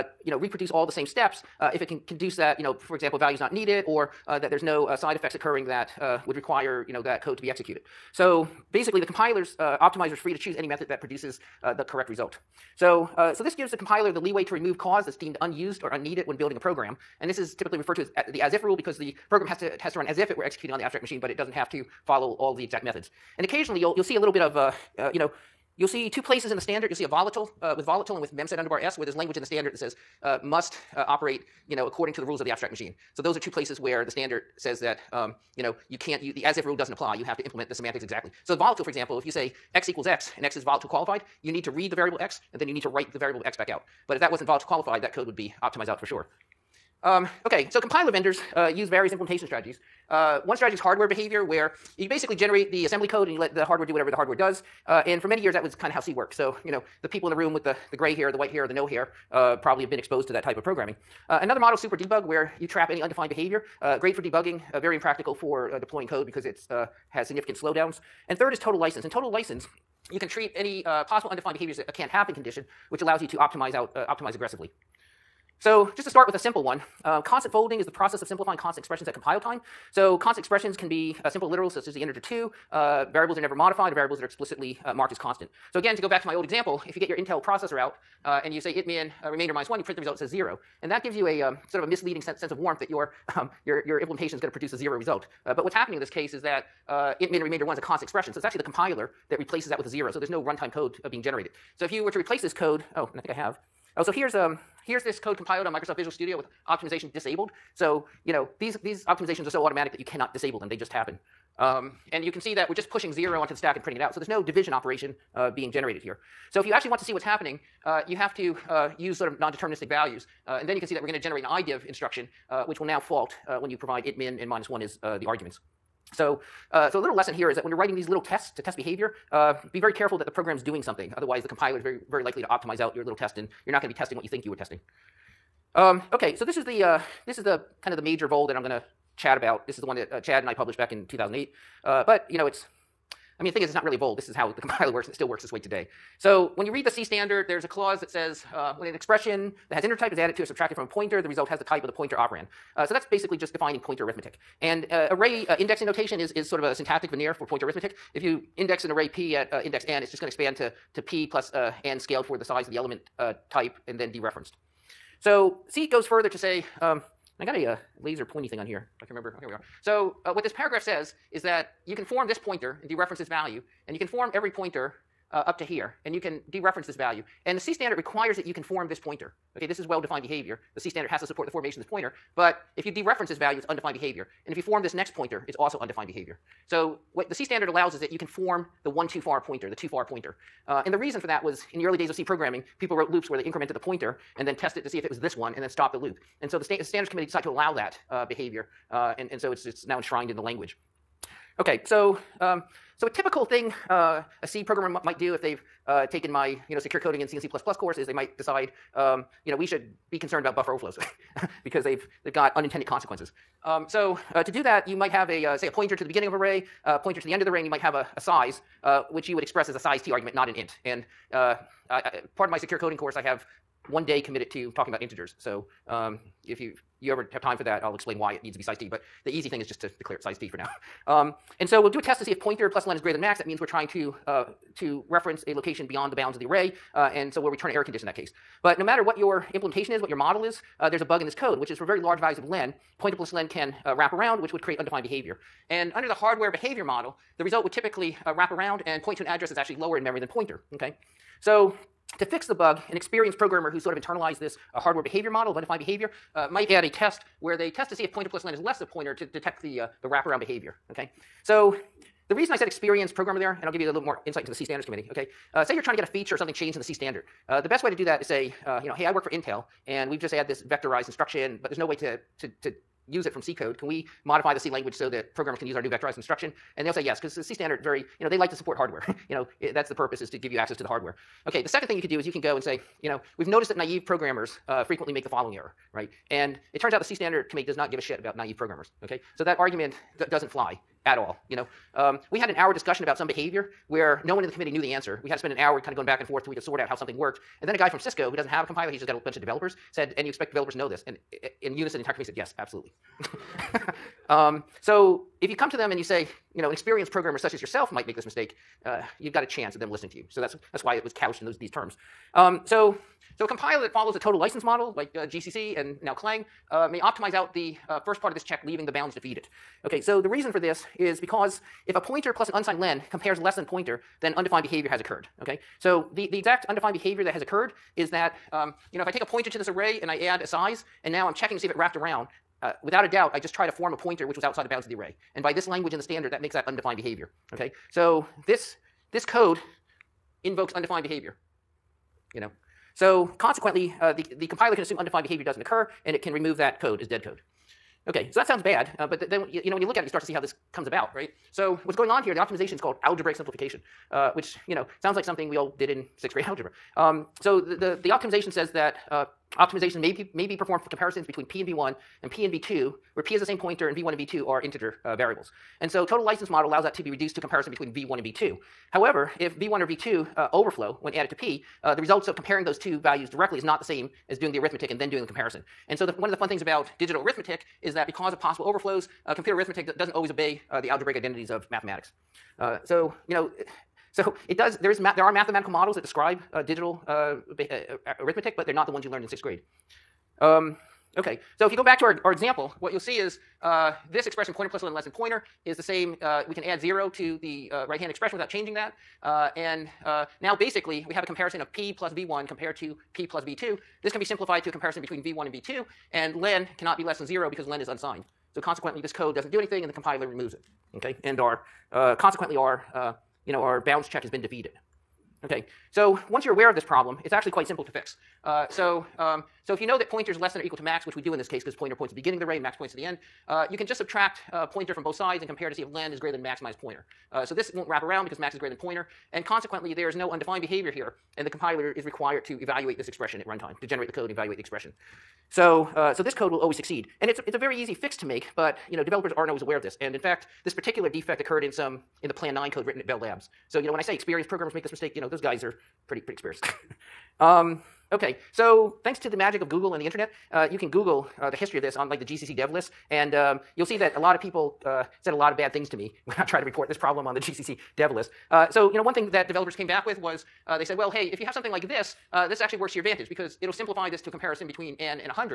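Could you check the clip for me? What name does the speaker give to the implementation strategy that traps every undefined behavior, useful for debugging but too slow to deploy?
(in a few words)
Super debug.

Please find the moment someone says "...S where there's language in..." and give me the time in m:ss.
0:28.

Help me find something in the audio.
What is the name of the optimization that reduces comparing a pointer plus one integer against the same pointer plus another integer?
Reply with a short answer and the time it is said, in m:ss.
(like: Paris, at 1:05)
Algebraic simplification, at 5:53.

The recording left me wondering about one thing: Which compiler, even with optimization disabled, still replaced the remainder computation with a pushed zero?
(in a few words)
Microsoft Visual Studio.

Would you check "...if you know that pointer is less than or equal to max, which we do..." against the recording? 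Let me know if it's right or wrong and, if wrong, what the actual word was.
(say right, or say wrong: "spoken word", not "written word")
right.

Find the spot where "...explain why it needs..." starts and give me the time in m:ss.
3:47.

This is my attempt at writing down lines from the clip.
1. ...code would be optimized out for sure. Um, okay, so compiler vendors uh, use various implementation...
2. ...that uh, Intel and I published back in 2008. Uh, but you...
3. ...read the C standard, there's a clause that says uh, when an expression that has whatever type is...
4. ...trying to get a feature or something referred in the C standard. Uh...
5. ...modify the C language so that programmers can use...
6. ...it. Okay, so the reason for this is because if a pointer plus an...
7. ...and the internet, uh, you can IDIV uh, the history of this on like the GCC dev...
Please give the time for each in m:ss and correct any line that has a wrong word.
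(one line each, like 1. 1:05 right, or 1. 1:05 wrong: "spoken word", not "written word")
1. 0:45 right
2. 2:19 wrong: "Chad", not "Intel"
3. 2:26 wrong: "integer", not "whatever"
4. 4:25 wrong: "changed", not "referred"
5. 4:34 right
6. 5:19 right
7. 7:29 wrong: "Google", not "IDIV".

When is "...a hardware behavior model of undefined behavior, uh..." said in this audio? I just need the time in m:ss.
4:14.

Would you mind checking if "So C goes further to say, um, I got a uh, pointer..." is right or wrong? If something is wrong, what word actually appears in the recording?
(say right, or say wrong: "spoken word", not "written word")
wrong: "laser", not "pointer".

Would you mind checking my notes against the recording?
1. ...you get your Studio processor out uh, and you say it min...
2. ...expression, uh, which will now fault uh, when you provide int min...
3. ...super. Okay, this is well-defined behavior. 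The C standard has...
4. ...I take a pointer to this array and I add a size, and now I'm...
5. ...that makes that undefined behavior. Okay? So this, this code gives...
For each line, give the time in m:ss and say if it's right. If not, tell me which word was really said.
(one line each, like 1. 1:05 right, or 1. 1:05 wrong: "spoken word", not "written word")
1. 1:26 wrong: "Intel", not "Studio"
2. 2:01 wrong: "instruction", not "expression"
3. 2:58 wrong: "pointer", not "super"
4. 5:29 right
5. 5:36 wrong: "invokes", not "gives".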